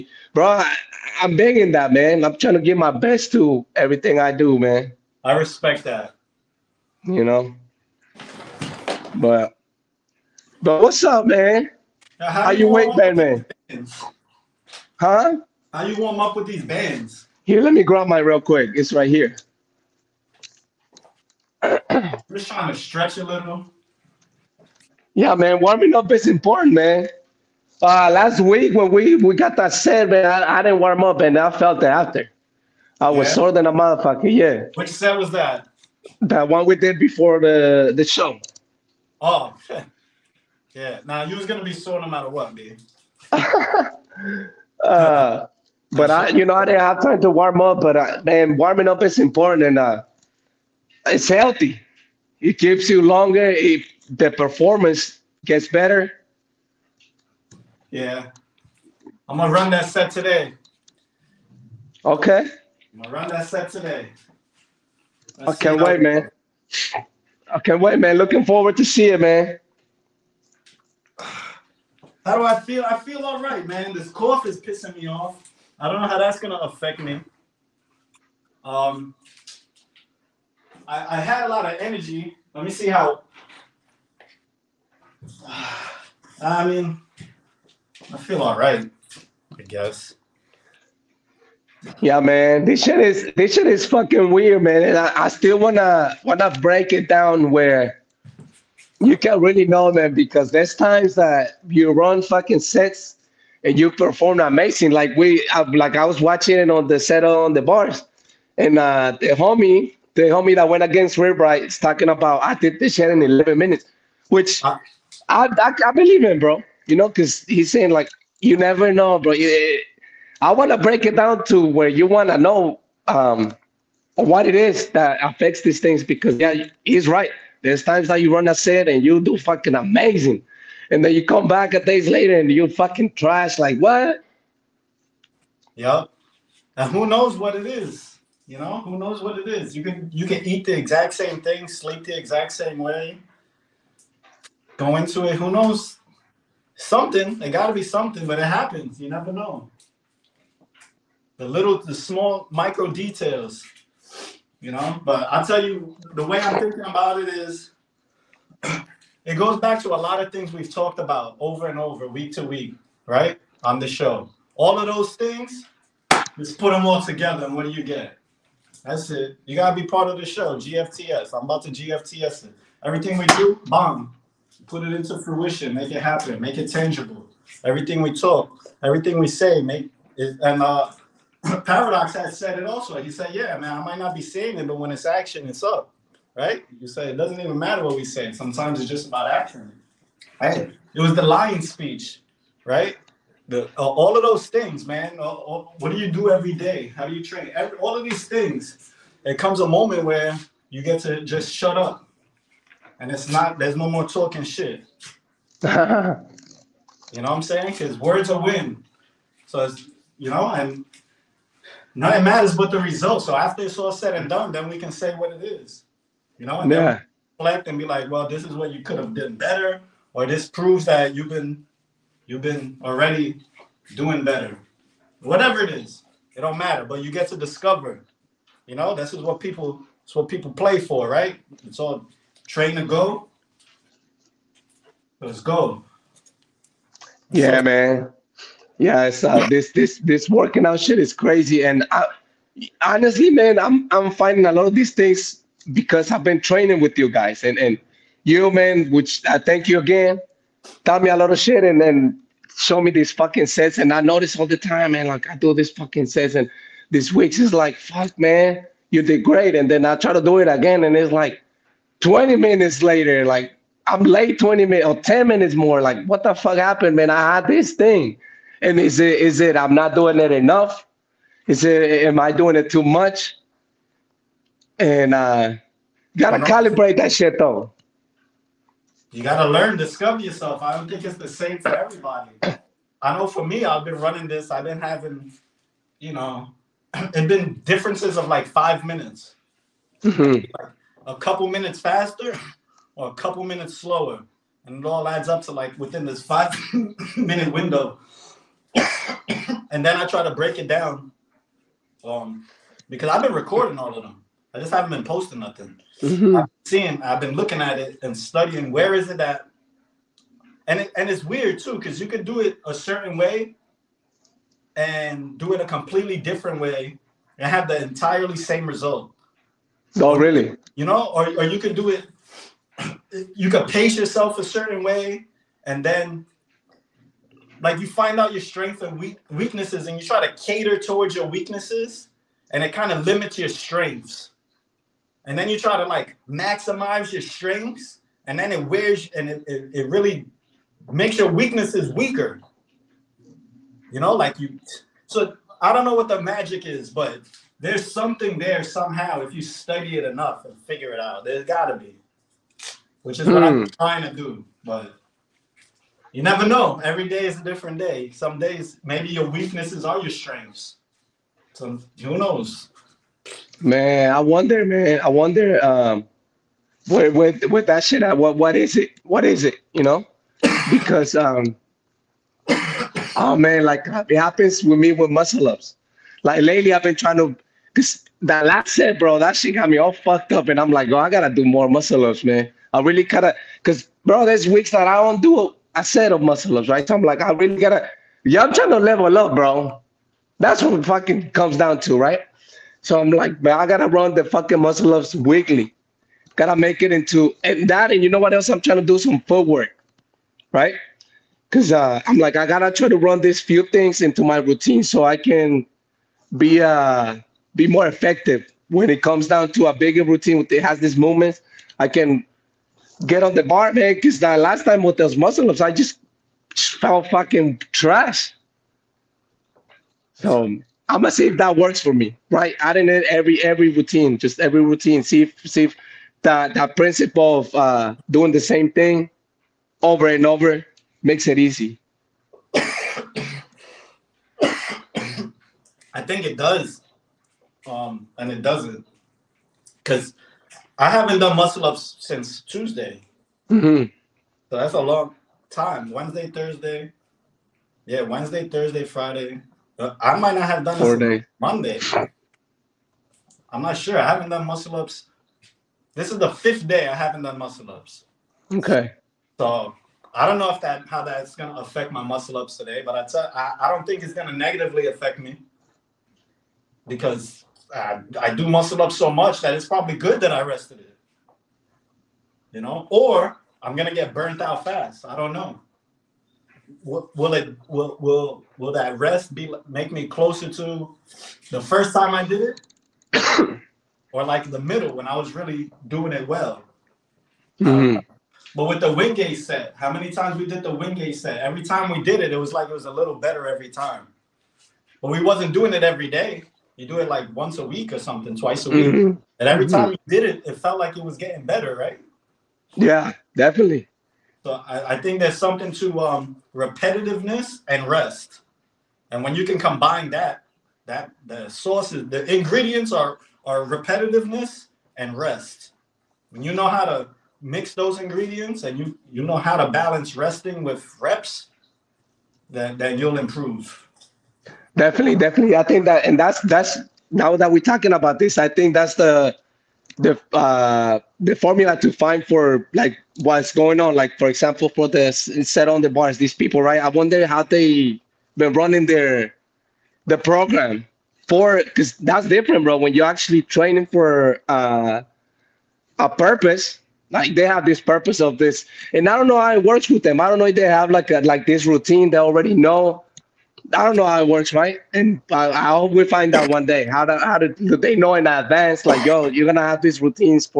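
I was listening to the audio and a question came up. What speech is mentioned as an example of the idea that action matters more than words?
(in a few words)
the lion speech.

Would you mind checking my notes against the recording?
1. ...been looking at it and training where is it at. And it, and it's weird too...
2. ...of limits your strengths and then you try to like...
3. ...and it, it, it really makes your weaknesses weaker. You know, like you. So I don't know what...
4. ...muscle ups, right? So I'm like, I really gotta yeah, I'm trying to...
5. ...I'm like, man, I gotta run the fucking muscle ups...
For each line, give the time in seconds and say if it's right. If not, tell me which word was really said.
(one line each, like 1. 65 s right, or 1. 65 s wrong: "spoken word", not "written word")
1. 307 s wrong: "studying", not "training"
2. 332 s right
3. 339 s right
4. 386 s right
5. 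392 s right.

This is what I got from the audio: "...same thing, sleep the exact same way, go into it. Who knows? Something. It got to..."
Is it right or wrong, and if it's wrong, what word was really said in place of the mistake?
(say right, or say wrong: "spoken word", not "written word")
right.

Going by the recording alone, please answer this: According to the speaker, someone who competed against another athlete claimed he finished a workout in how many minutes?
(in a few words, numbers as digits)
11 minutes.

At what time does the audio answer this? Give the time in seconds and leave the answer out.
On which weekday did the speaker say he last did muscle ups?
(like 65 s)
442 s.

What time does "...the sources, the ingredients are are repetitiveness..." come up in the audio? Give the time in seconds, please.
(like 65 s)
511 s.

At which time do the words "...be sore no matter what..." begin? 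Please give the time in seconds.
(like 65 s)
41 s.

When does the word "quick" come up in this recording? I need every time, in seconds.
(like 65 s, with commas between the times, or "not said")
18 s.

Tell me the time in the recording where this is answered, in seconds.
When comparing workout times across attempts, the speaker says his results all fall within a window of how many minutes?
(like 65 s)
296 s.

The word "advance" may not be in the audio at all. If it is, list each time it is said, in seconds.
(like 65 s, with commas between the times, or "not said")
558 s.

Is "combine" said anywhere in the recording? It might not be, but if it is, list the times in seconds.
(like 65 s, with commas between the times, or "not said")
509 s.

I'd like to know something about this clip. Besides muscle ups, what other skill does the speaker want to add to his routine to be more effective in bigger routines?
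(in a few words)
footwork.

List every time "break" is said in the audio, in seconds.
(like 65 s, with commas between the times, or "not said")
96 s, 120 s, 300 s.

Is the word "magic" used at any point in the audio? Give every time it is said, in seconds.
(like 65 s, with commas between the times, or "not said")
346 s.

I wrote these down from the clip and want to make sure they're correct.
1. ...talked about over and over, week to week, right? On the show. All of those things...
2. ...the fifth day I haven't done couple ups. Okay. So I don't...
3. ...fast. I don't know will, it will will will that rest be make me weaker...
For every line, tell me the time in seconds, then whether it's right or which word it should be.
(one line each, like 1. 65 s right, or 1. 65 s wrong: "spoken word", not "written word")
1. 160 s right
2. 456 s wrong: "muscle", not "couple"
3. 474 s wrong: "closer", not "weaker".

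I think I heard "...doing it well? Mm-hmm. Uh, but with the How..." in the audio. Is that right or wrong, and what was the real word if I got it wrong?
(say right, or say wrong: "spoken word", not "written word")
wrong: "Wingate", not "How".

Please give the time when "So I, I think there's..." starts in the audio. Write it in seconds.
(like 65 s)
504 s.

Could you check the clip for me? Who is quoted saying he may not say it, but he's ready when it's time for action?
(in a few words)
Paradox.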